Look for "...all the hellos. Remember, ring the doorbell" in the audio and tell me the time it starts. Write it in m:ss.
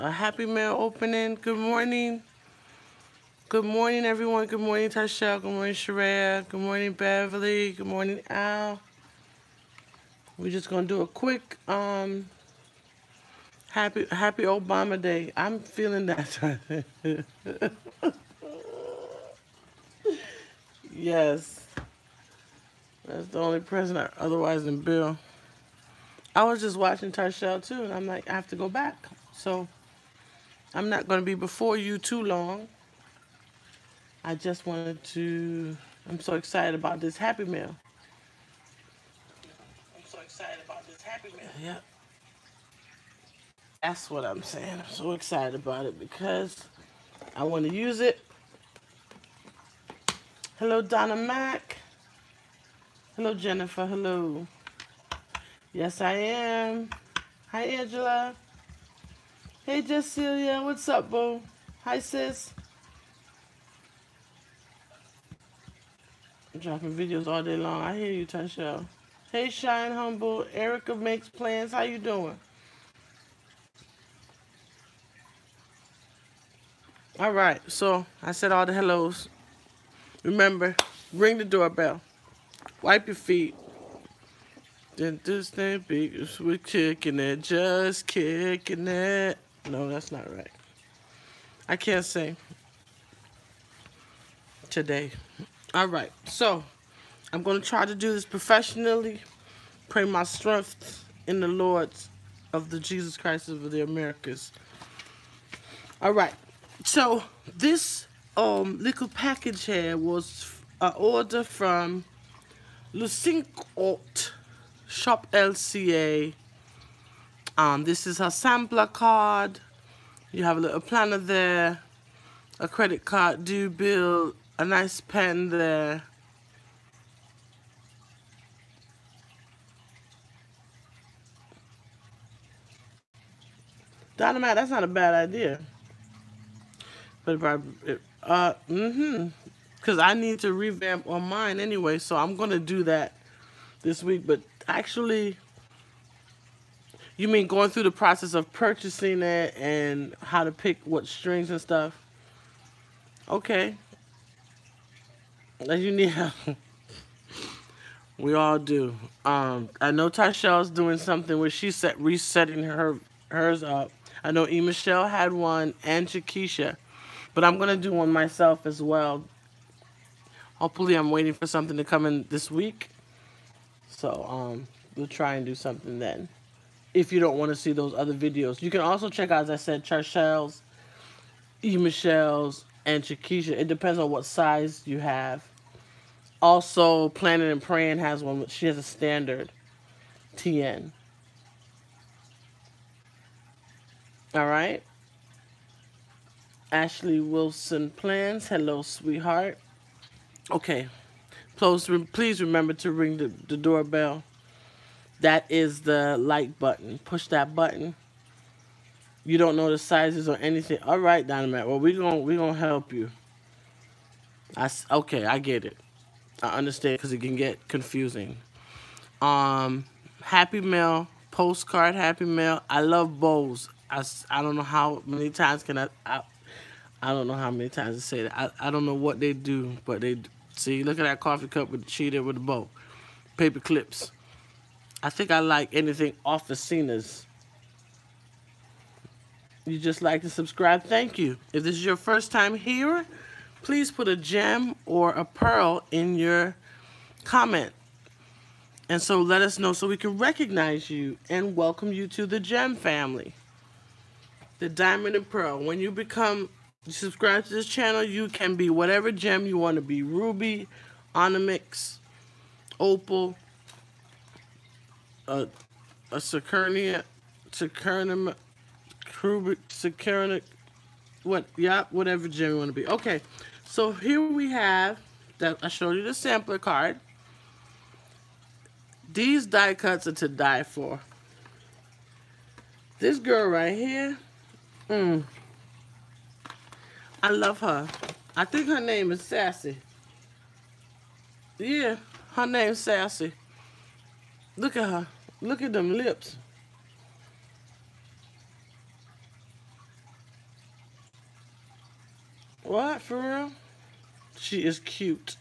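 1:18.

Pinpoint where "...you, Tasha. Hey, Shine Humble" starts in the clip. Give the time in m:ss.
1:08.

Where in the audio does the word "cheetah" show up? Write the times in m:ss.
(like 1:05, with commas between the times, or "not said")
3:51.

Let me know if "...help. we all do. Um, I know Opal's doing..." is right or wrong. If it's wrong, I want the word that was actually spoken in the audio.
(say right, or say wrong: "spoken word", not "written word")
wrong: "Tyshell", not "Opal".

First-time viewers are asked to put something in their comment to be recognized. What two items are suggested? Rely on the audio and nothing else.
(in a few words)
a gem or a pearl.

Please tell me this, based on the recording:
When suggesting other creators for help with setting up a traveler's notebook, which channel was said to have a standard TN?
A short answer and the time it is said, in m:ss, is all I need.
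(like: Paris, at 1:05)
Planning and Praying, at 3:07.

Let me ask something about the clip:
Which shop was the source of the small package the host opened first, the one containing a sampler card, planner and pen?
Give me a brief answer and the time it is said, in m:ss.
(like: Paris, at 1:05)
Le Cinq Aout Shop, at 1:52.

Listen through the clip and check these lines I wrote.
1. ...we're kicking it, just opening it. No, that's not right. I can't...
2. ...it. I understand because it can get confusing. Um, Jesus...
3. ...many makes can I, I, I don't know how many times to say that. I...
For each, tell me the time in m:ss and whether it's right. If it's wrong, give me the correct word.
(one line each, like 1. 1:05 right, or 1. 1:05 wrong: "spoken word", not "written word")
1. 1:26 wrong: "kicking", not "opening"
2. 3:35 wrong: "Happy", not "Jesus"
3. 3:45 wrong: "times", not "makes".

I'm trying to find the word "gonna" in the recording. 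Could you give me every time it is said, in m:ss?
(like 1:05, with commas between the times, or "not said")
2:47, 3:32.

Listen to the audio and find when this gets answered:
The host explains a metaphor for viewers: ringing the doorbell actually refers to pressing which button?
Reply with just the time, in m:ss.
3:25.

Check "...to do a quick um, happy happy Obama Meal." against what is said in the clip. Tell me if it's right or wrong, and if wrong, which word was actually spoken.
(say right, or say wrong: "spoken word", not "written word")
wrong: "Day", not "Meal".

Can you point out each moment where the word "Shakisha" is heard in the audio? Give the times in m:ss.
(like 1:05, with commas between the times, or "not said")
2:46, 3:03.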